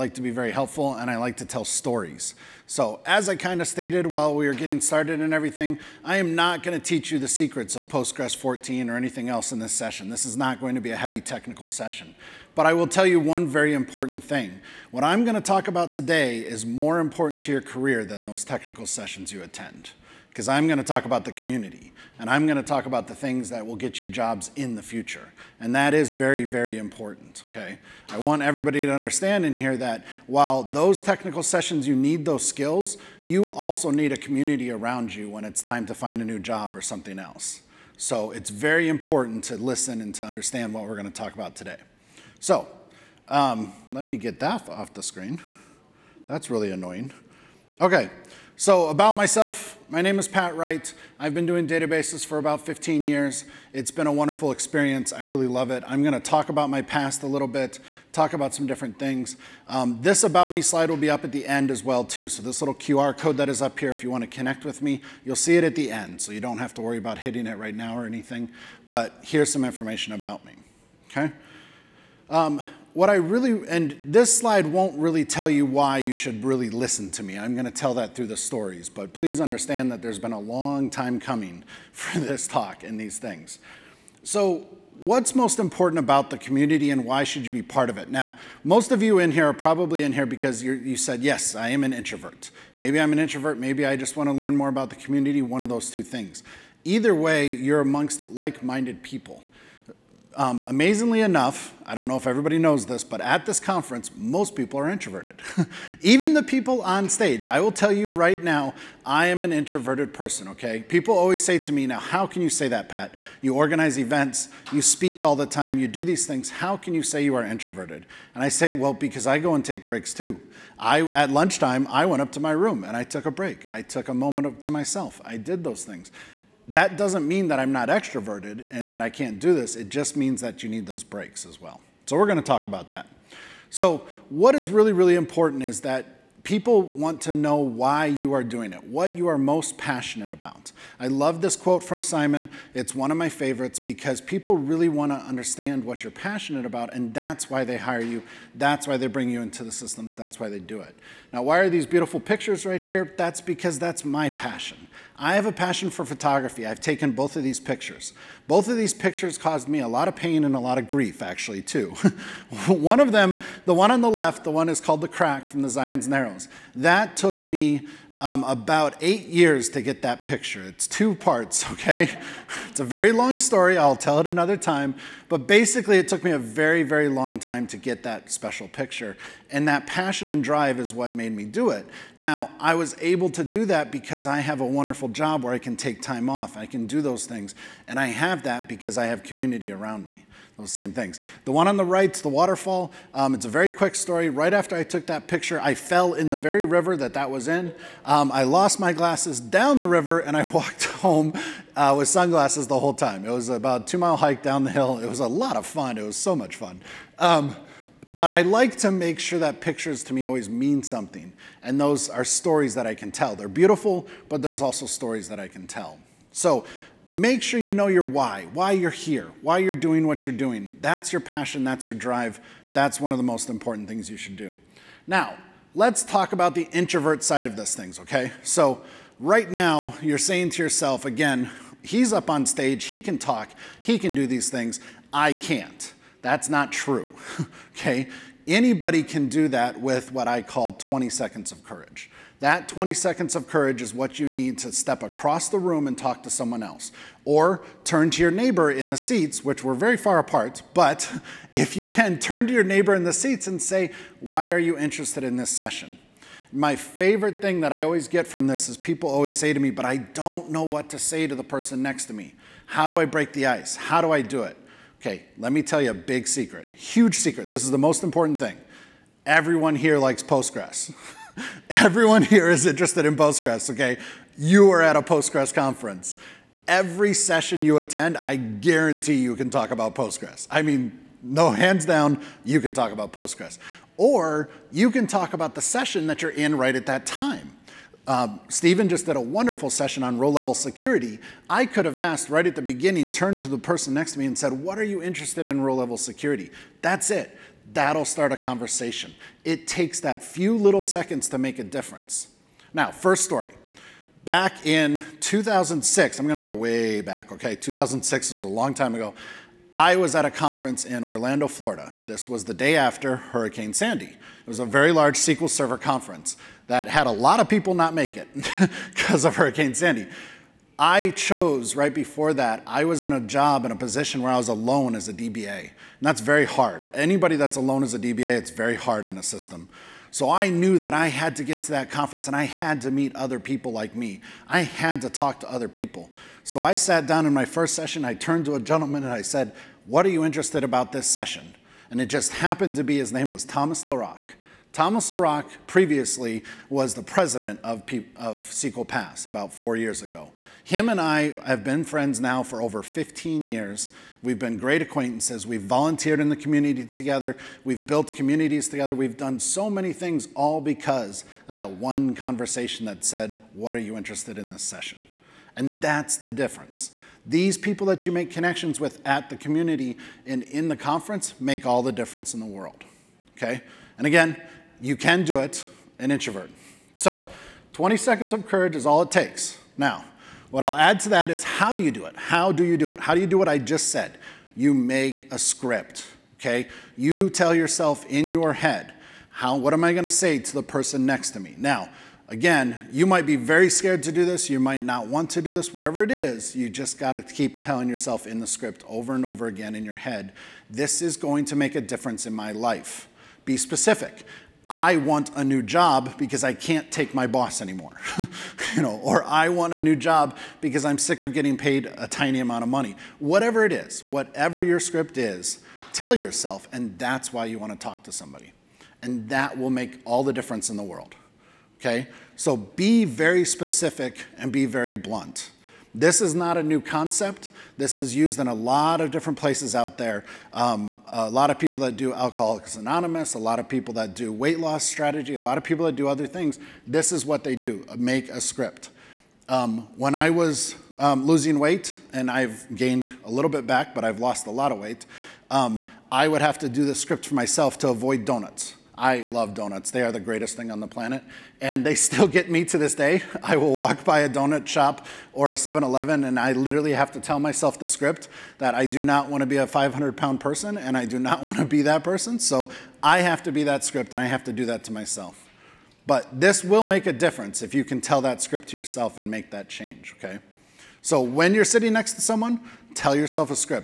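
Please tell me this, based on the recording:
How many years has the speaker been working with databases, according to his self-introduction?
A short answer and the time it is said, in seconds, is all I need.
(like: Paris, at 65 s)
15, at 52 s.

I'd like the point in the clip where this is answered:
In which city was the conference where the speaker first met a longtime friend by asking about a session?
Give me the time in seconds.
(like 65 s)
311 s.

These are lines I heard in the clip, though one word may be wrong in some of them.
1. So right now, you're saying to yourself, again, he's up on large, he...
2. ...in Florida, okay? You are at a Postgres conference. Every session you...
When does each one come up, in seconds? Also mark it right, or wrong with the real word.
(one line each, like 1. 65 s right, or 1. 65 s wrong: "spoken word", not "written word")
1. 228 s wrong: "stage", not "large"
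2. 273 s wrong: "Postgres", not "Florida".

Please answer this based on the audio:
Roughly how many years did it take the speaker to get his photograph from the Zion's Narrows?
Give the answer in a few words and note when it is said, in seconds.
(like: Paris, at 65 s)
8, at 169 s.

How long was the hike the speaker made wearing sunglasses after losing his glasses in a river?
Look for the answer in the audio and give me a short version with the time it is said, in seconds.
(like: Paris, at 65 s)
2 miles, at 203 s.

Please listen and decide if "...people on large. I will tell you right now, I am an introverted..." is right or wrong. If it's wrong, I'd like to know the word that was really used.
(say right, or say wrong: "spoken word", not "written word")
wrong: "stage", not "large".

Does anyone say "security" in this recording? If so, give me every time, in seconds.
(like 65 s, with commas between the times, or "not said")
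290 s, 295 s.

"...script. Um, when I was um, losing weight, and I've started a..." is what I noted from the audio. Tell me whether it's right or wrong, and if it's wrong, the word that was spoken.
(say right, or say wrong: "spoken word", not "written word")
wrong: "gained", not "started".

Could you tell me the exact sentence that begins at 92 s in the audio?
Maybe I'm an introvert, maybe I just want to learn more about the community, one of those two things.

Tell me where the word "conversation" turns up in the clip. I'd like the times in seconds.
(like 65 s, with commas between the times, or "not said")
298 s, 362 s.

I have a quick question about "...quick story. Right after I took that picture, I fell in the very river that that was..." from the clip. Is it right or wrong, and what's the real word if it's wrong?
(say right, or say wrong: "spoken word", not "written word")
right.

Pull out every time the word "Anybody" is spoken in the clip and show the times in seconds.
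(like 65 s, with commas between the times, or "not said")
238 s, 326 s.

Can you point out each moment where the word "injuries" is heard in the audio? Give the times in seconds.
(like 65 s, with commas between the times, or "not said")
not said.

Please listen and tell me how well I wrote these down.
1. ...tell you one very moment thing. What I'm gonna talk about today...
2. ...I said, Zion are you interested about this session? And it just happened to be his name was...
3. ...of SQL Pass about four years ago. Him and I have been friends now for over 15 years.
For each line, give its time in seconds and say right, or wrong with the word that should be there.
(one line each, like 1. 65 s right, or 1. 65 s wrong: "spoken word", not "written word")
1. 12 s wrong: "important", not "moment"
2. 339 s wrong: "What", not "Zion"
3. 348 s right.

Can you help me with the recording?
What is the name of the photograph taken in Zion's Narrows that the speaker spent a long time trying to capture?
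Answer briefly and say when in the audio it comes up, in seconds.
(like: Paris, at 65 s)
The Crack, at 165 s.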